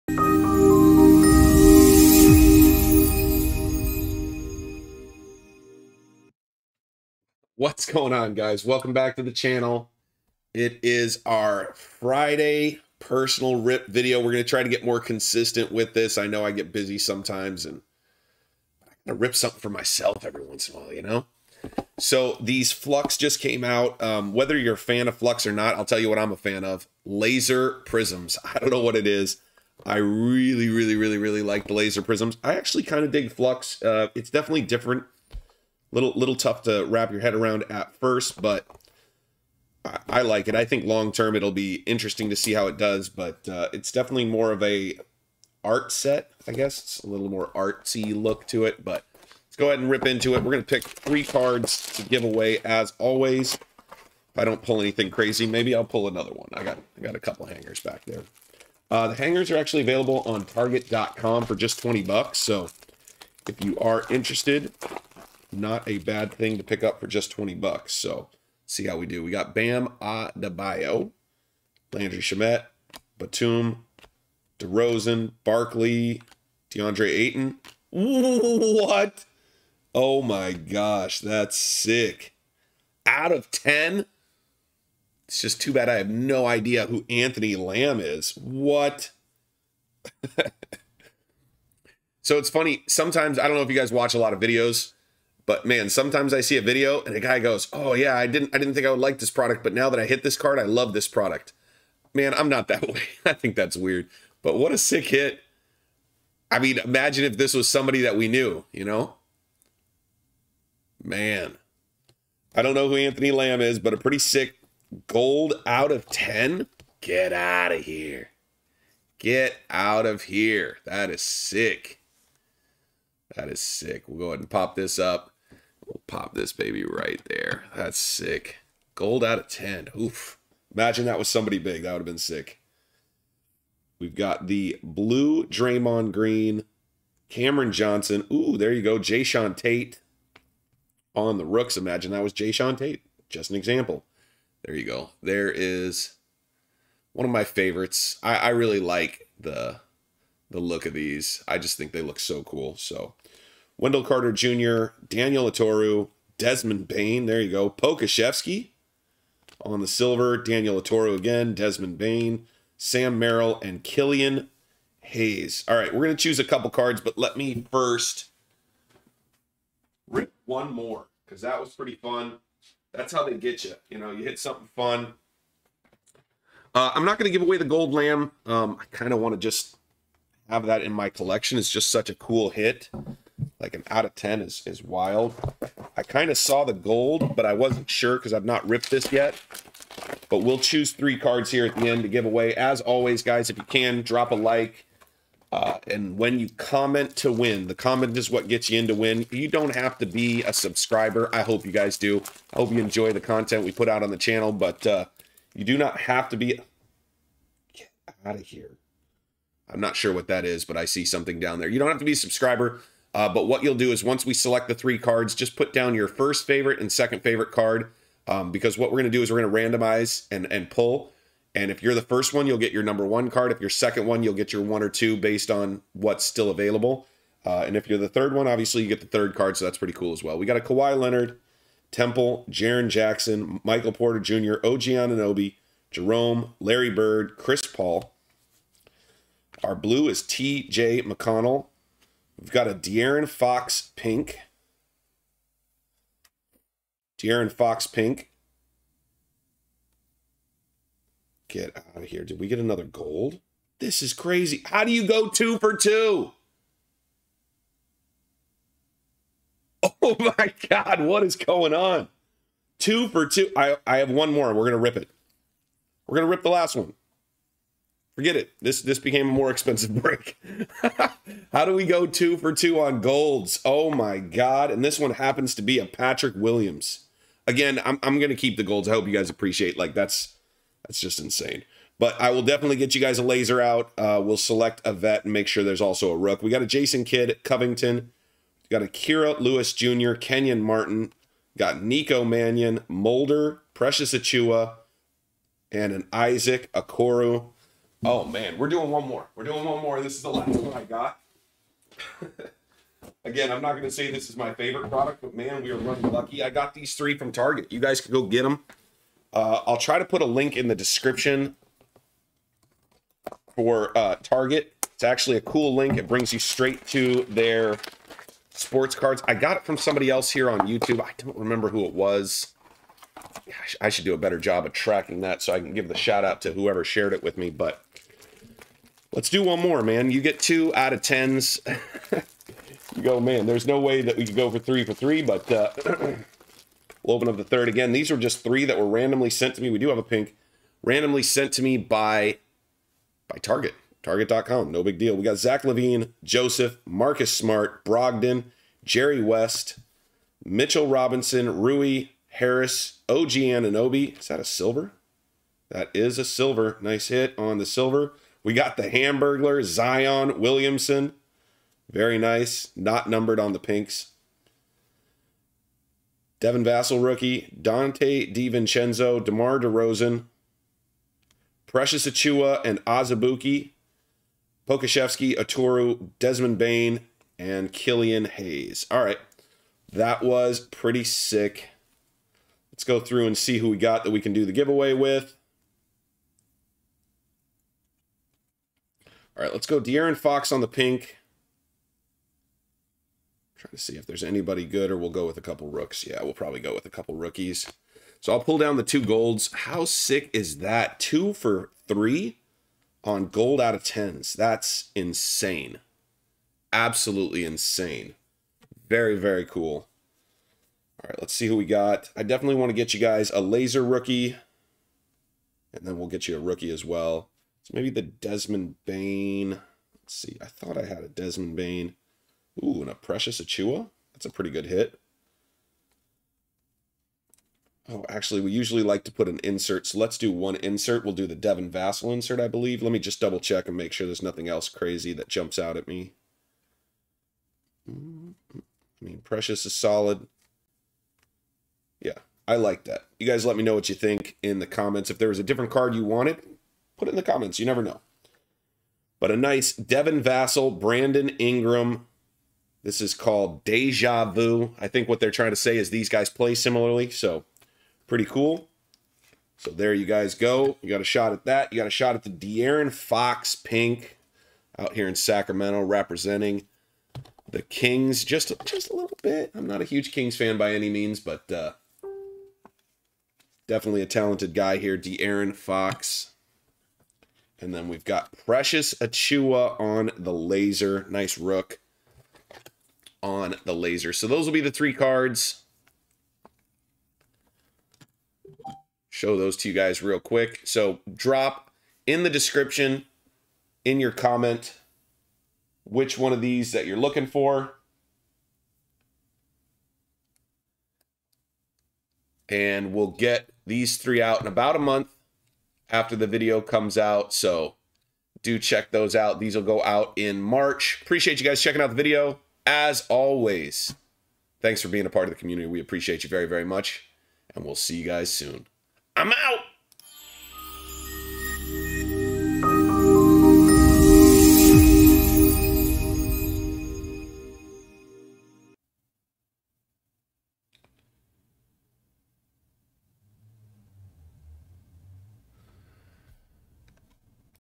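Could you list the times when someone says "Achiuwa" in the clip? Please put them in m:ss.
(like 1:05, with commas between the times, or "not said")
4:54, 6:12, 7:03, 7:58.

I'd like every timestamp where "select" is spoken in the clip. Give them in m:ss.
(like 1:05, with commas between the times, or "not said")
3:34, 4:44.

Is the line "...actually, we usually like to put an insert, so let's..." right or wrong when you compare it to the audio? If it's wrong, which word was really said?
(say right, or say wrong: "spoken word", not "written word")
right.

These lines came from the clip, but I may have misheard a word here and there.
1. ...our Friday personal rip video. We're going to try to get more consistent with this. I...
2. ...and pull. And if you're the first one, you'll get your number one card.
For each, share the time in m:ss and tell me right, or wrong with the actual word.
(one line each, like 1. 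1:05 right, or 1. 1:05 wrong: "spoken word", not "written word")
1. 0:11 right
2. 3:40 right.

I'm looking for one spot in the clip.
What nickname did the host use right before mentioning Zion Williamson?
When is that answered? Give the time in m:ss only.
5:58.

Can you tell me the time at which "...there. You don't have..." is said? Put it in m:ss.
3:31.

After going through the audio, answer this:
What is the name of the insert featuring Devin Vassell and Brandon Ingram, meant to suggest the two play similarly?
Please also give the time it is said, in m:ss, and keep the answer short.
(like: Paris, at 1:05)
Deja Vu, at 7:33.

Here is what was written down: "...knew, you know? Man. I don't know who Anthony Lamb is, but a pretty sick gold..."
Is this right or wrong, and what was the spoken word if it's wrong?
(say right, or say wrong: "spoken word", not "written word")
right.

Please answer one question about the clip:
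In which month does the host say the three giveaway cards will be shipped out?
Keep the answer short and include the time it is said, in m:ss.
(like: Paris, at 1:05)
March, at 8:30.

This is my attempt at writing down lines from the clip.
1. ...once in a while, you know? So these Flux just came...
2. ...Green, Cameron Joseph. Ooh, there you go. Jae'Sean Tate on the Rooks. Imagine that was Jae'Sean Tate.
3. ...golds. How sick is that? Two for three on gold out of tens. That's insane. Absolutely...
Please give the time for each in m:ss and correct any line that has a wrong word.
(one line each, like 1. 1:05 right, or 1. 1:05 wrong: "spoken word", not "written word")
1. 0:20 right
2. 2:16 wrong: "Johnson", not "Joseph"
3. 6:39 right.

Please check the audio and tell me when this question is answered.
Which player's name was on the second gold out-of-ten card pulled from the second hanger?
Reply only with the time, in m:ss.
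4:35.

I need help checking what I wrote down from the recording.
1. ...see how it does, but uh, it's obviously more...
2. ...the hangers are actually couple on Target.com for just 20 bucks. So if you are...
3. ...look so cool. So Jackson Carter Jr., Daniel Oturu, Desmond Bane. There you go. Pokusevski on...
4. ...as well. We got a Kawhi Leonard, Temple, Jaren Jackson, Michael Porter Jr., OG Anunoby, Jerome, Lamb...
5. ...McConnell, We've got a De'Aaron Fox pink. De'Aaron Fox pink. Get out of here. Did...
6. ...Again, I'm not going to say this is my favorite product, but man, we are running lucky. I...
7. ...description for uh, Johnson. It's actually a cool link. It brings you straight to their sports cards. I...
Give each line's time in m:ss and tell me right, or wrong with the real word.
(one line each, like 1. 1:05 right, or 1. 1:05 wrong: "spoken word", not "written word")
1. 0:42 wrong: "definitely", not "obviously"
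2. 0:59 wrong: "available", not "couple"
3. 2:32 wrong: "Wendell", not "Jackson"
4. 3:50 wrong: "Larry", not "Lamb"
5. 4:01 right
6. 5:03 right
7. 5:10 wrong: "Target", not "Johnson".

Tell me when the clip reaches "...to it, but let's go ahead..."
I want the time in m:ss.
0:48.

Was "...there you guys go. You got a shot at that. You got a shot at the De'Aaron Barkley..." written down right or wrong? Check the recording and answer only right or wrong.
wrong.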